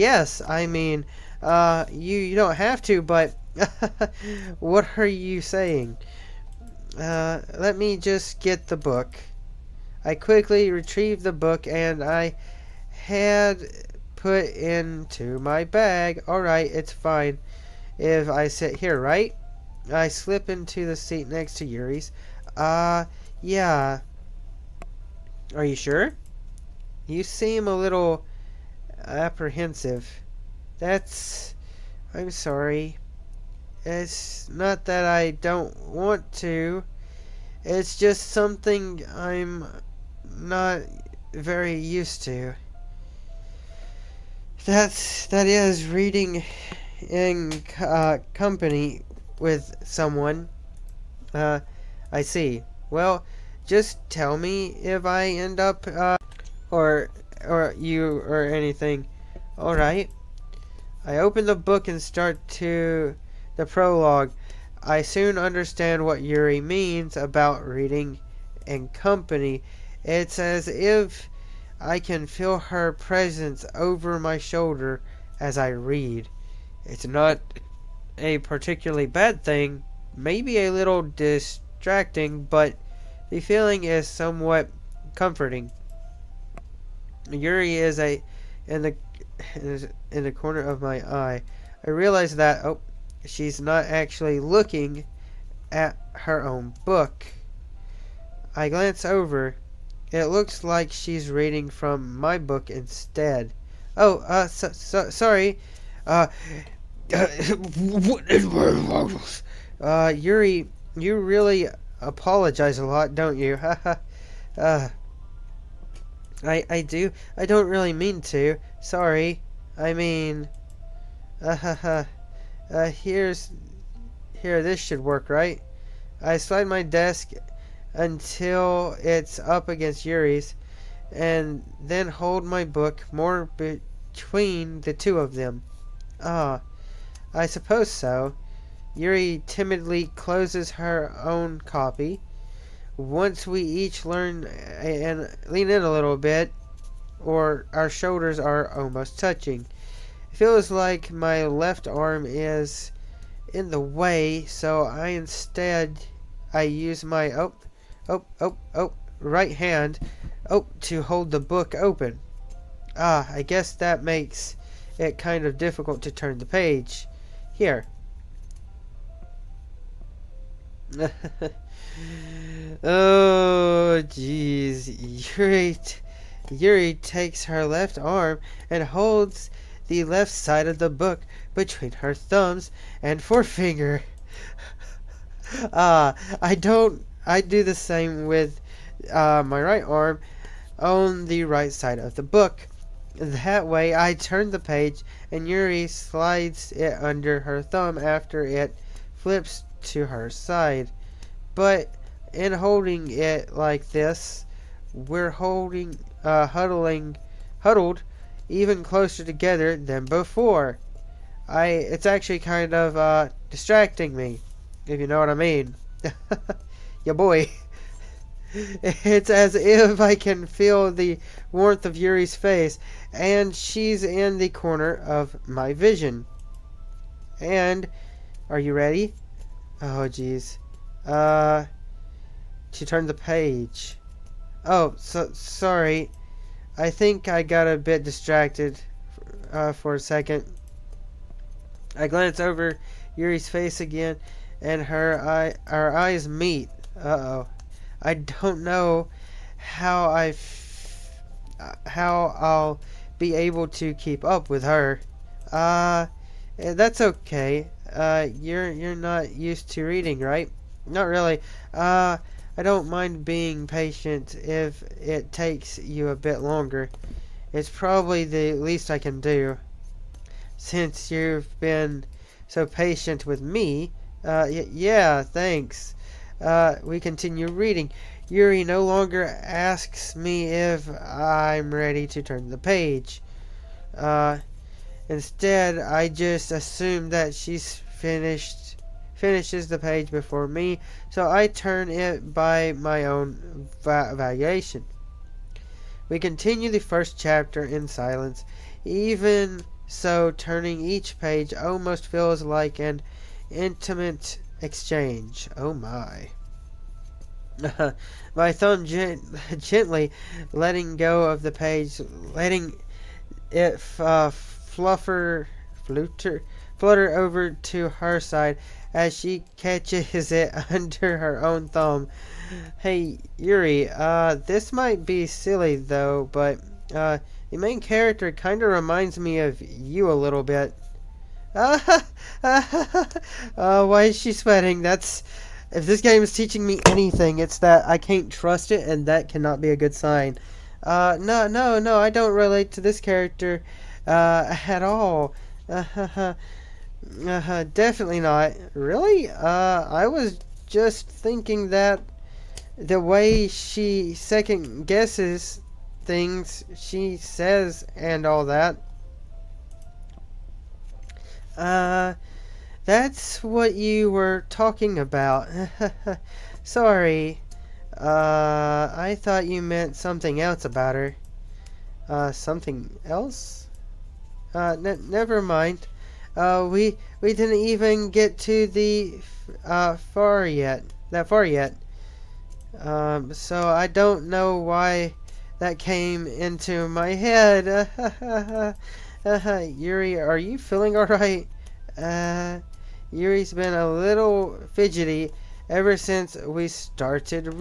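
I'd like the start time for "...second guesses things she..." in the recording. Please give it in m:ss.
5:54.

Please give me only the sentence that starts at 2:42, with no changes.
Ah, I guess that makes it kind of difficult to turn the page.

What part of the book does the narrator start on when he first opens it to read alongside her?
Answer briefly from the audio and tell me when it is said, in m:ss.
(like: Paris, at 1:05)
prologue, at 1:03.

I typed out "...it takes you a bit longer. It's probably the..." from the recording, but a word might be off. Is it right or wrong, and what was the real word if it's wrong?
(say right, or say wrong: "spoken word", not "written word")
right.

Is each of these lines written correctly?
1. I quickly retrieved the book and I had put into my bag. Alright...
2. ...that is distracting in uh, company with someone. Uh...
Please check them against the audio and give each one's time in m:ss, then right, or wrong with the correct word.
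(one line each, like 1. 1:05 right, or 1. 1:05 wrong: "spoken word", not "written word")
1. 0:10 right
2. 0:45 wrong: "reading", not "distracting".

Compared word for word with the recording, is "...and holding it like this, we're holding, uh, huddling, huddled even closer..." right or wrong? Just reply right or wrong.
right.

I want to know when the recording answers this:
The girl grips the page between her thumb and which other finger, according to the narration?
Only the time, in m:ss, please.
3:03.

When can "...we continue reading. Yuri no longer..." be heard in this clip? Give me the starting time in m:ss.
4:36.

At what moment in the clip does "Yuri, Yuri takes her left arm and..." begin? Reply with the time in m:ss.
2:55.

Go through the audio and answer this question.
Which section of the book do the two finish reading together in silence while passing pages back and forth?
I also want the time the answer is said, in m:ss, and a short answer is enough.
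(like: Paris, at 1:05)
first chapter, at 4:56.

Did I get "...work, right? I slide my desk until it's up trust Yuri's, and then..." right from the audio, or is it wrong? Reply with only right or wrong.
wrong.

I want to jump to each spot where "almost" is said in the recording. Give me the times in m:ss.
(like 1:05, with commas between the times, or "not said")
2:28, 5:01.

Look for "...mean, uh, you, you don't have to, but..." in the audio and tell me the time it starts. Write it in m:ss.
0:00.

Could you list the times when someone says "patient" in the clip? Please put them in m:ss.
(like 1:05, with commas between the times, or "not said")
4:23, 4:32.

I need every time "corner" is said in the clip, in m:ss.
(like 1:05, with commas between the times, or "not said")
1:30, 3:44.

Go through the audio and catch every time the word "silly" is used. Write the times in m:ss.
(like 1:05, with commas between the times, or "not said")
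5:25.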